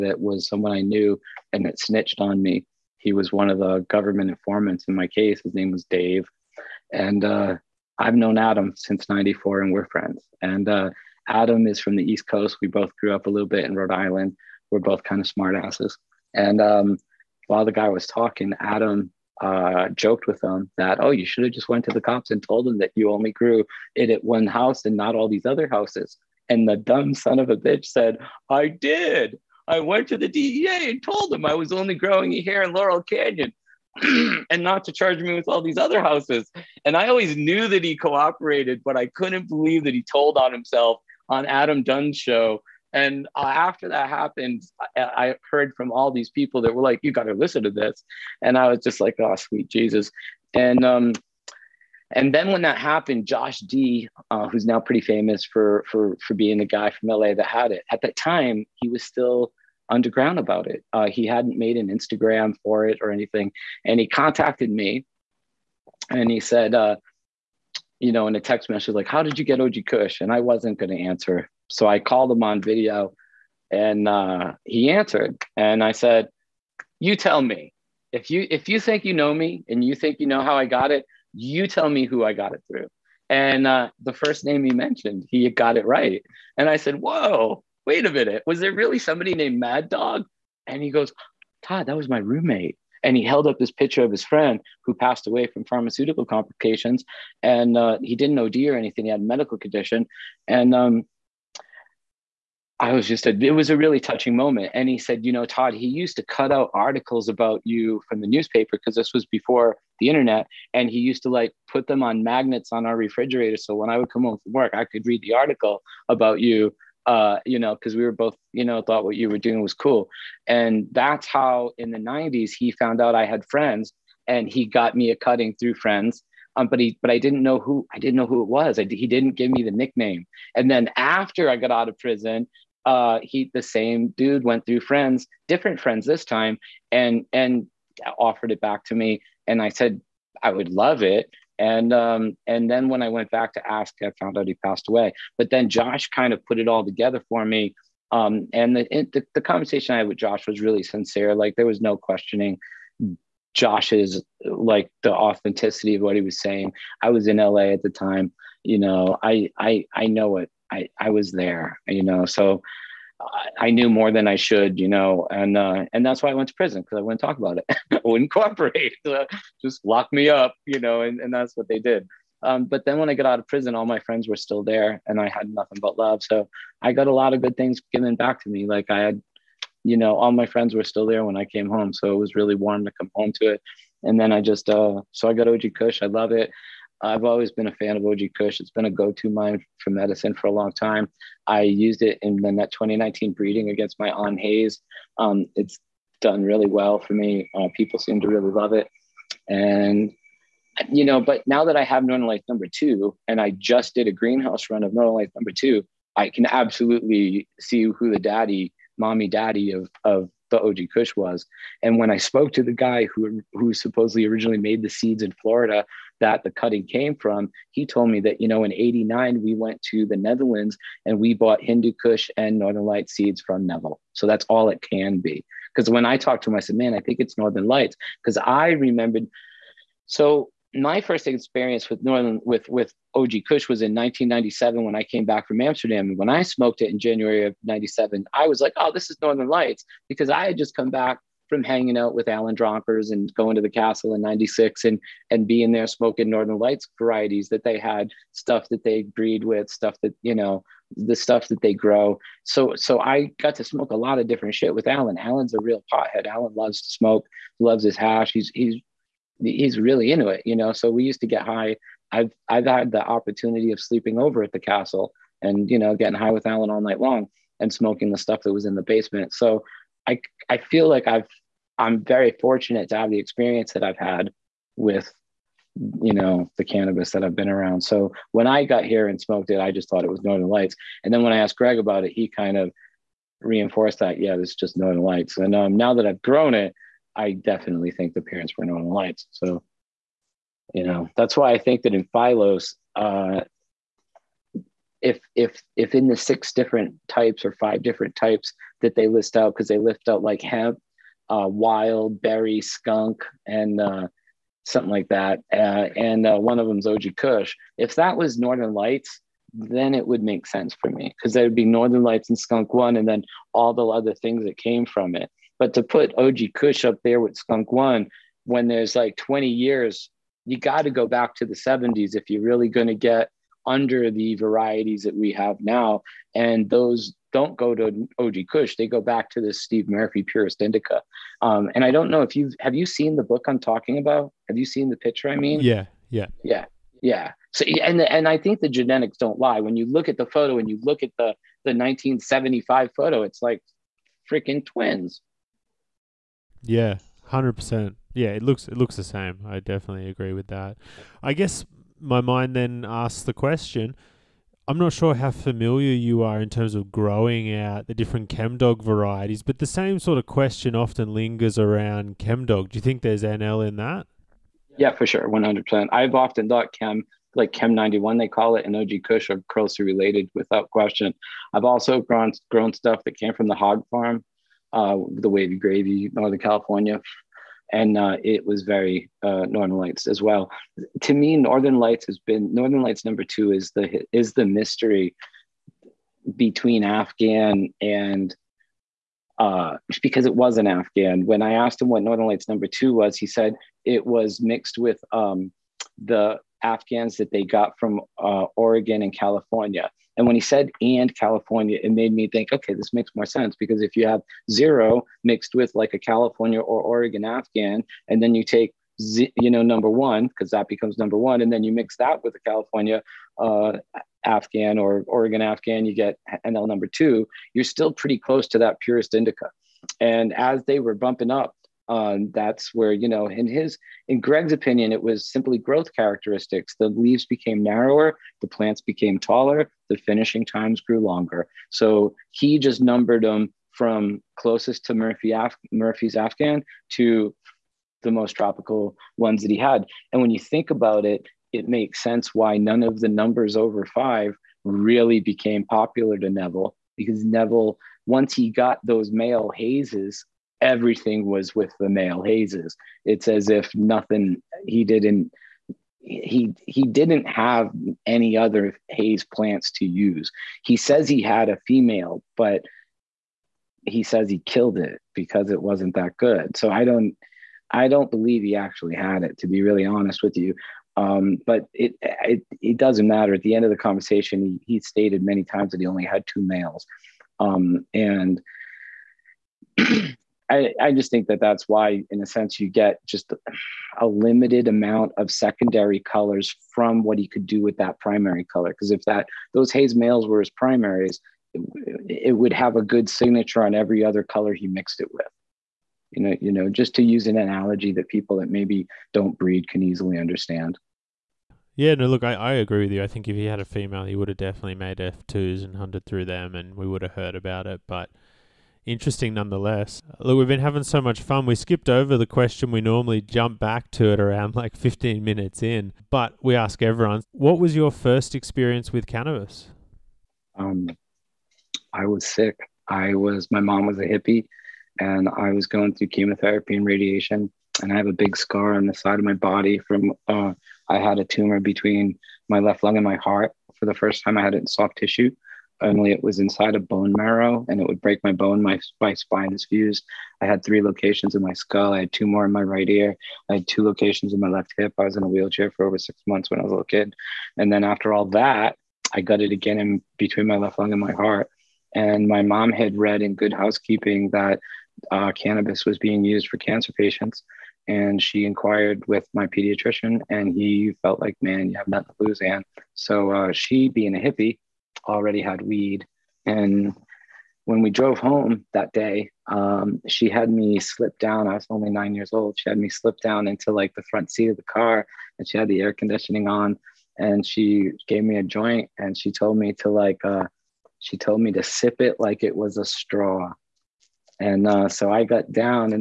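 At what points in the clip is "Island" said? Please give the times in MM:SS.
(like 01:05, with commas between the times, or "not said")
00:13.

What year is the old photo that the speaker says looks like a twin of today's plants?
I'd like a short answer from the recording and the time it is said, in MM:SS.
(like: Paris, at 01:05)
1975, at 05:41.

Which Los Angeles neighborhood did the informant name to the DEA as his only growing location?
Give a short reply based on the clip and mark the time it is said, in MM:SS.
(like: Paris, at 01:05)
Laurel Canyon, at 00:32.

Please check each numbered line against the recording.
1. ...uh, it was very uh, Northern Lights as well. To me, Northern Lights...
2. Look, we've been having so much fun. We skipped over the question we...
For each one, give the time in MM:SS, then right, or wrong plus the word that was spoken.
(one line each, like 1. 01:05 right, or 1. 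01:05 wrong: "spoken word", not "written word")
1. 06:17 right
2. 08:30 right.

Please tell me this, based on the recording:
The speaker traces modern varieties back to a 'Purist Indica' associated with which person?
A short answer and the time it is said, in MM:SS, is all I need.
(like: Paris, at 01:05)
Steve Murphy, at 05:29.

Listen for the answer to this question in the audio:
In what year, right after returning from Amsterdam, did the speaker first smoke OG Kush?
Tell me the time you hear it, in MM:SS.
03:53.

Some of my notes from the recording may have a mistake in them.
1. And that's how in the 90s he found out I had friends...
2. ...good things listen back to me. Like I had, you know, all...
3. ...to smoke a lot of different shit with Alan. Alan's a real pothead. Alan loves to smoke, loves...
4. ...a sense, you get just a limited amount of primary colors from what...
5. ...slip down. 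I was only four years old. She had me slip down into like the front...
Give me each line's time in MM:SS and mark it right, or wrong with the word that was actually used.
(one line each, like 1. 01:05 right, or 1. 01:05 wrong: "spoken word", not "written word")
1. 02:00 right
2. 02:57 wrong: "given", not "listen"
3. 04:13 right
4. 08:02 wrong: "secondary", not "primary"
5. 09:30 wrong: "nine", not "four".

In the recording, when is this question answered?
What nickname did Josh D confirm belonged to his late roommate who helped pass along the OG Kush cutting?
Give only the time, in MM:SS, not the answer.
01:29.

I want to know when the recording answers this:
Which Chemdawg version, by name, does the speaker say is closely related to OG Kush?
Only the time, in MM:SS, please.
06:07.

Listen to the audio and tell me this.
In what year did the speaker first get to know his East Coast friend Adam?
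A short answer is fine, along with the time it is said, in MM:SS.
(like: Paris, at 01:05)
1994, at 00:09.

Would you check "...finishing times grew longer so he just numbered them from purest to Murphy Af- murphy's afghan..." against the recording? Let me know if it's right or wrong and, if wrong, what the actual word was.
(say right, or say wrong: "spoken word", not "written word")
wrong: "closest", not "purest".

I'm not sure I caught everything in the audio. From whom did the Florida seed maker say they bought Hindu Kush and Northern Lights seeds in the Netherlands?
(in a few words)
Neville.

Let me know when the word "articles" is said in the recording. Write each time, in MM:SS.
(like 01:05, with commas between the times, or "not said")
01:46, 01:55.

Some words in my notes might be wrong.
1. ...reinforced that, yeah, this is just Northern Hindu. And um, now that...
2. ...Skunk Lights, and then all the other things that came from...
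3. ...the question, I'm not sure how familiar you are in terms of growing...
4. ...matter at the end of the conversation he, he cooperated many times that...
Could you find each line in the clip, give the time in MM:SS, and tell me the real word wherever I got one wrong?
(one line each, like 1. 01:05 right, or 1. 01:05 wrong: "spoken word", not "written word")
1. 04:43 wrong: "Lights", not "Hindu"
2. 05:12 wrong: "One", not "Lights"
3. 05:53 right
4. 07:53 wrong: "stated", not "cooperated".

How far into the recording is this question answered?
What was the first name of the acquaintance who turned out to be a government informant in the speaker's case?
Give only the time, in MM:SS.
00:05.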